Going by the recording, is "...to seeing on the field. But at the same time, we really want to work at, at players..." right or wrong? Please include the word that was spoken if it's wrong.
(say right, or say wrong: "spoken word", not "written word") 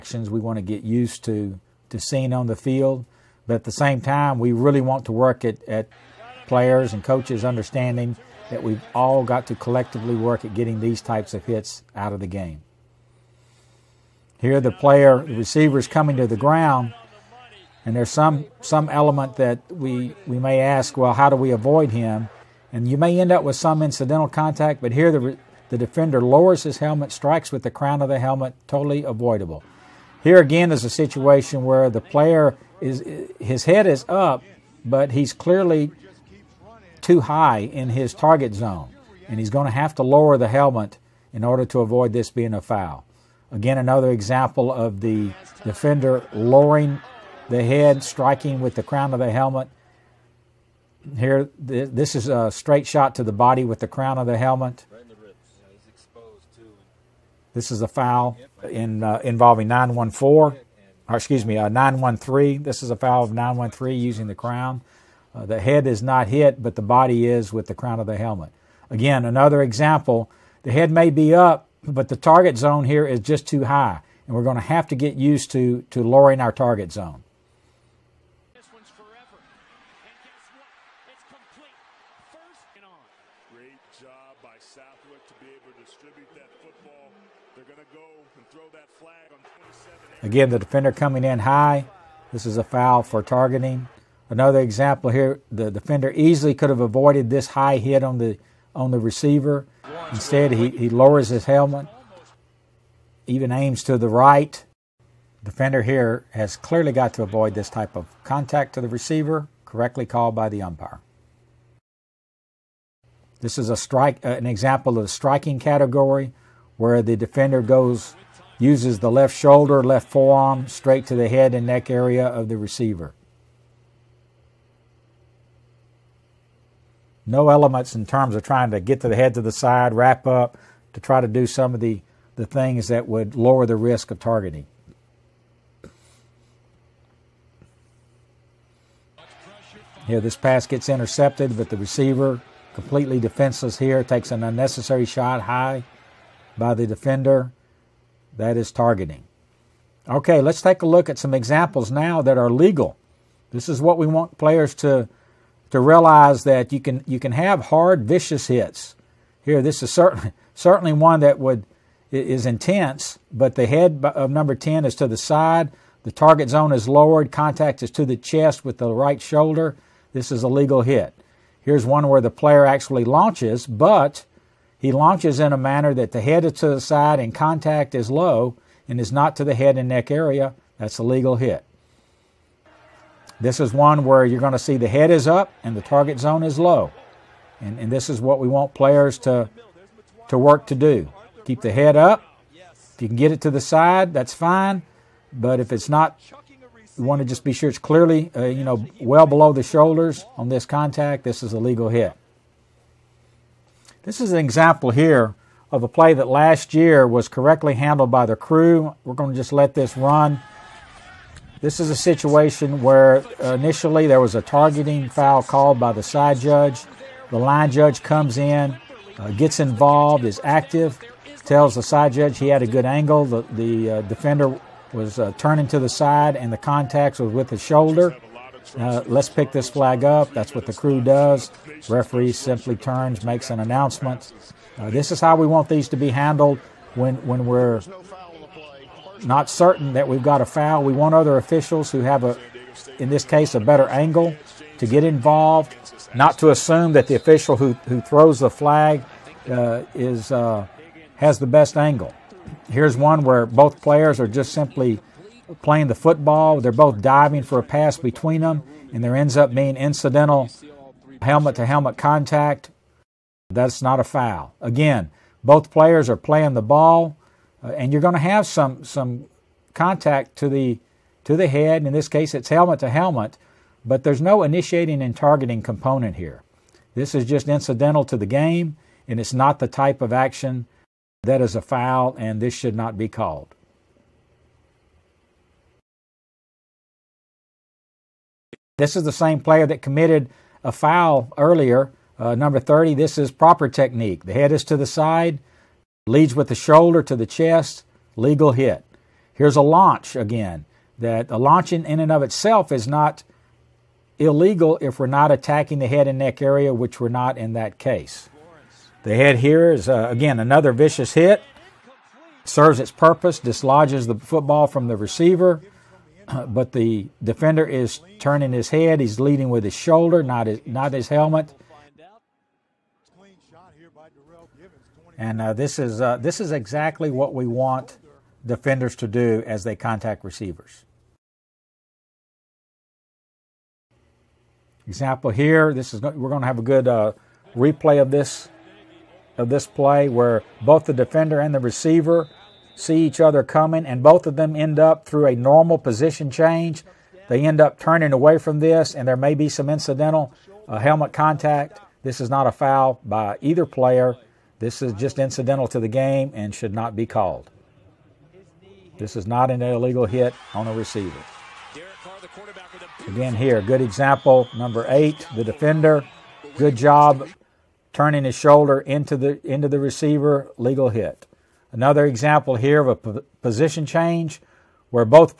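right.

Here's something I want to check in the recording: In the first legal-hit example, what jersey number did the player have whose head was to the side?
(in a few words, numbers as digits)
10.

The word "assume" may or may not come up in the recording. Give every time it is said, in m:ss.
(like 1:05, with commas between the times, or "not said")
4:06.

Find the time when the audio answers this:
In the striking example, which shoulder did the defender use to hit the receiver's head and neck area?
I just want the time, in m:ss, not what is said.
1:59.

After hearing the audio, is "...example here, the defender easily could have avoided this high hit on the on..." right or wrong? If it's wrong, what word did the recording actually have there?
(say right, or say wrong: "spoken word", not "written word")
right.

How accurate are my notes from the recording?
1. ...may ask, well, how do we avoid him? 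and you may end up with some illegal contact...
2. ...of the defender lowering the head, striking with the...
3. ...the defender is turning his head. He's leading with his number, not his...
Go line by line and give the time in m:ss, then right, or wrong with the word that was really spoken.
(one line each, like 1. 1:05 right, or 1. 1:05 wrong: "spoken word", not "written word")
1. 0:20 wrong: "incidental", not "illegal"
2. 0:44 right
3. 5:16 wrong: "shoulder", not "number".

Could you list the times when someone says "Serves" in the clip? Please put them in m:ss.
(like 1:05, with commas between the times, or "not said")
5:12.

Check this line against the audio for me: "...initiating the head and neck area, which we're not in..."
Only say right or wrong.
wrong.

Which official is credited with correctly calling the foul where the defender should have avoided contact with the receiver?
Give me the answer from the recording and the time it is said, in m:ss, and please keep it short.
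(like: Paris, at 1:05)
the umpire, at 1:50.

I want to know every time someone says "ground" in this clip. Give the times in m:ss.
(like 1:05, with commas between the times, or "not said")
0:16.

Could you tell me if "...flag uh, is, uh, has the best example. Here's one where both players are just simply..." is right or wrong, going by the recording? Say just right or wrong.
wrong.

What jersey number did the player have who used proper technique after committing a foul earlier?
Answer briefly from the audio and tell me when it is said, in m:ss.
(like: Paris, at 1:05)
30, at 4:52.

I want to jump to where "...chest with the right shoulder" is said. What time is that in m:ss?
2:48.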